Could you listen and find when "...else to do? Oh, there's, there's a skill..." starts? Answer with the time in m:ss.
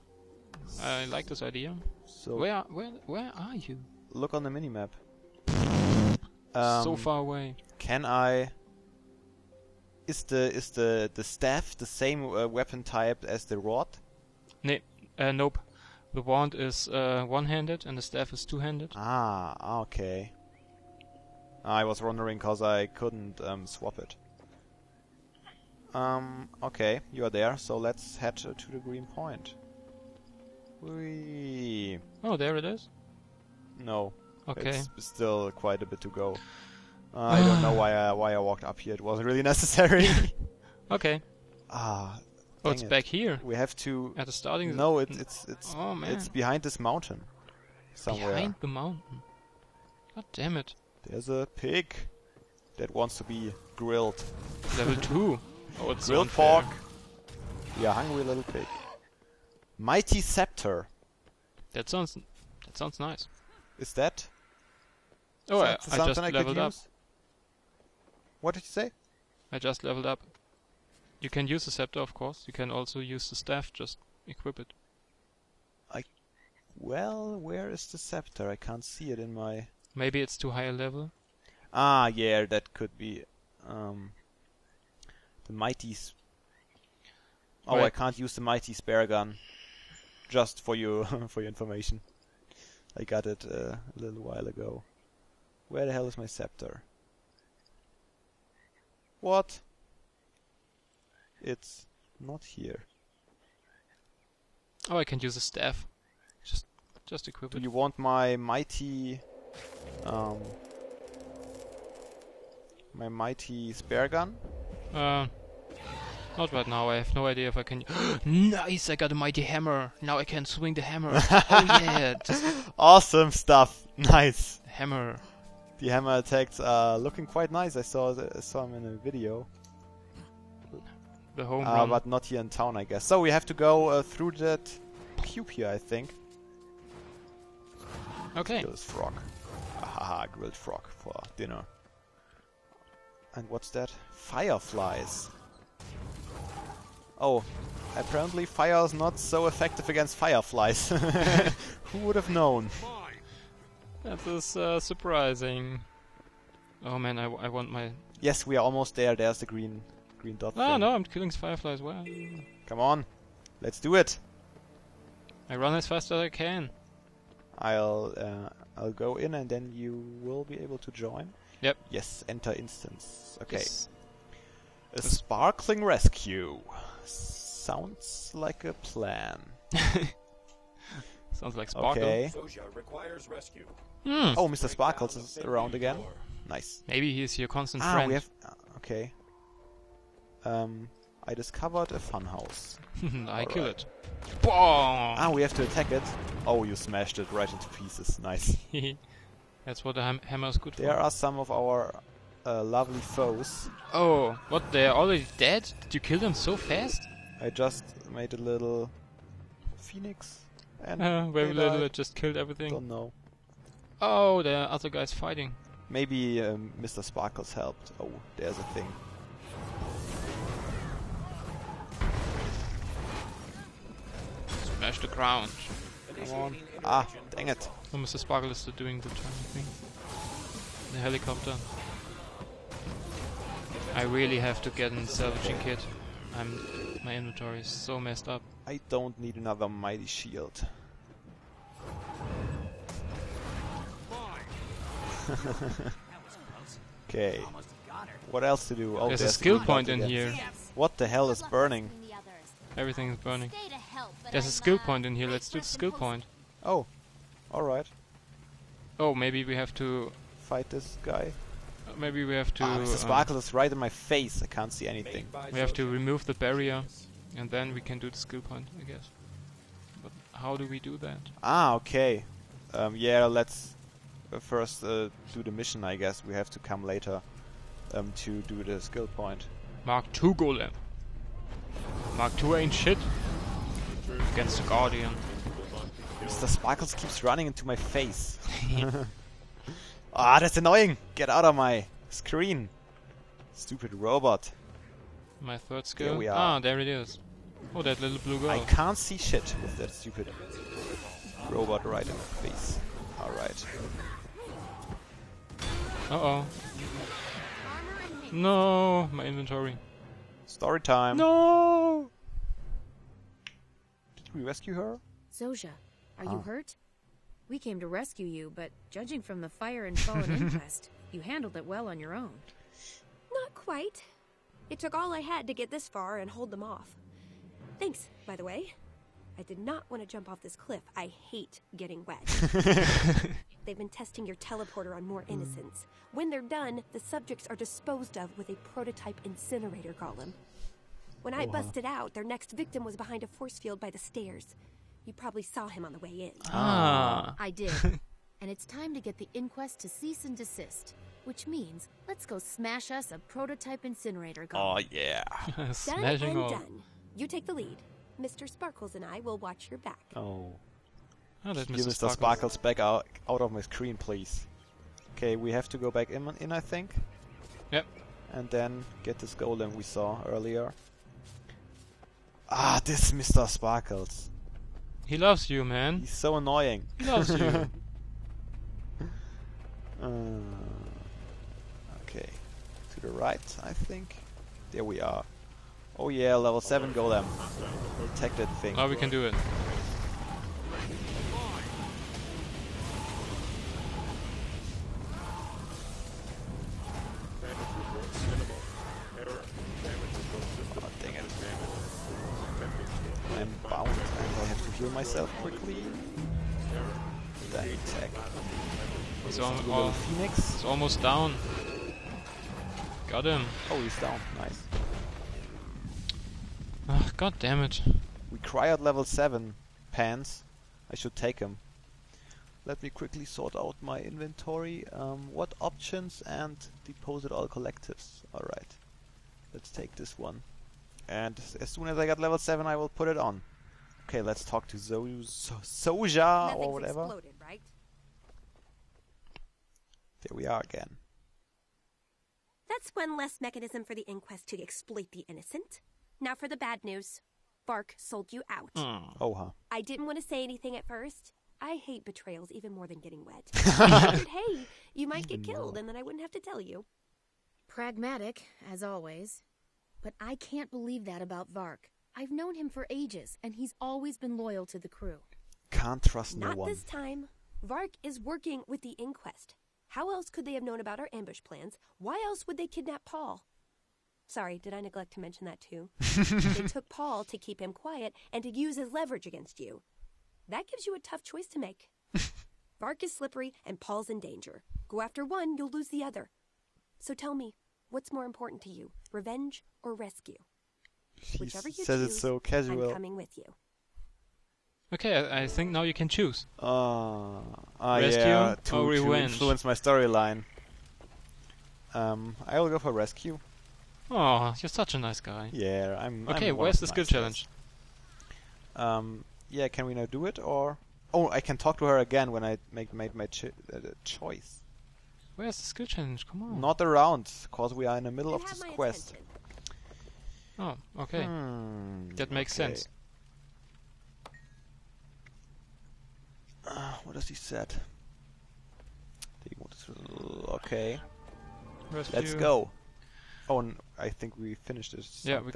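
4:08.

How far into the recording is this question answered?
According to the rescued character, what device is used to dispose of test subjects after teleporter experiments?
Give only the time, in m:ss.
5:38.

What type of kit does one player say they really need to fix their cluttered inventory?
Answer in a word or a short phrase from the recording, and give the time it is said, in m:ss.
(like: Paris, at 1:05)
Salvaging kit, at 3:55.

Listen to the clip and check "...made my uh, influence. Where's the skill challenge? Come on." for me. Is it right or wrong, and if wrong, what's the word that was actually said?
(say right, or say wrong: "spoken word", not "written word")
wrong: "choice", not "influence".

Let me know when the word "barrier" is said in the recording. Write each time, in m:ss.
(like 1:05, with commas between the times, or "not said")
4:26.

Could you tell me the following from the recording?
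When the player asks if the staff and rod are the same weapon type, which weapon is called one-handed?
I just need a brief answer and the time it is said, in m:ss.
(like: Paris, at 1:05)
The wand, at 0:16.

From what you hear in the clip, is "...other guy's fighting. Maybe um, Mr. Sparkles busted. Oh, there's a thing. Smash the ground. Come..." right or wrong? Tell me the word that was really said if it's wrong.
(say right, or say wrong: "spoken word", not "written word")
wrong: "helped", not "busted".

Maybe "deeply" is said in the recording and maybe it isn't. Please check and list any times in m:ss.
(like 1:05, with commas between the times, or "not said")
not said.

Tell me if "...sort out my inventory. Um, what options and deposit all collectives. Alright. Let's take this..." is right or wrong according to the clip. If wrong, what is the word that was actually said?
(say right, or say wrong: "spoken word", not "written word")
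right.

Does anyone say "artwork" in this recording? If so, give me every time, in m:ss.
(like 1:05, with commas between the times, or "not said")
not said.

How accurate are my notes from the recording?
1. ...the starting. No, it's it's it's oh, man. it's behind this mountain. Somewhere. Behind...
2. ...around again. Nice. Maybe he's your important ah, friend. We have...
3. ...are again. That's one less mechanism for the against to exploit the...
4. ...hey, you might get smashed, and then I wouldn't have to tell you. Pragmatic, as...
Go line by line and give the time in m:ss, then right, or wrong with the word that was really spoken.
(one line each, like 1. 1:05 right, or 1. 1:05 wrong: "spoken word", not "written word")
1. 0:44 right
2. 3:05 wrong: "constant", not "important"
3. 7:20 wrong: "inquest", not "against"
4. 7:34 wrong: "killed", not "smashed".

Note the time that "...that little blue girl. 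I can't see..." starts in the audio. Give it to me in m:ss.
4:57.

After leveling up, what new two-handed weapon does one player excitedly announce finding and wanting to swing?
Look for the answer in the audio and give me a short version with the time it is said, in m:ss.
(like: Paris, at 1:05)
Mighty hammer, at 1:59.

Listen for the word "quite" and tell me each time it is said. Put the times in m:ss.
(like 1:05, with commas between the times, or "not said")
0:35, 2:07, 5:23.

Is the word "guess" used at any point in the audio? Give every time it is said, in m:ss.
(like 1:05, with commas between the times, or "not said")
2:12, 4:28, 4:35.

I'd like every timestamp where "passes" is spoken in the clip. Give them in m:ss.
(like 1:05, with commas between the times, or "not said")
not said.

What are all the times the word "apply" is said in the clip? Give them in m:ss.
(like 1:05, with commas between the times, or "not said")
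not said.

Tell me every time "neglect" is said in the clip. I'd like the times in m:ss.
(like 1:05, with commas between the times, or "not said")
7:54.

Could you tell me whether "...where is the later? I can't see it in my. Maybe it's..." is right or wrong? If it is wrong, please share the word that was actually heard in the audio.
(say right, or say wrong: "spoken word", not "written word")
wrong: "scepter", not "later".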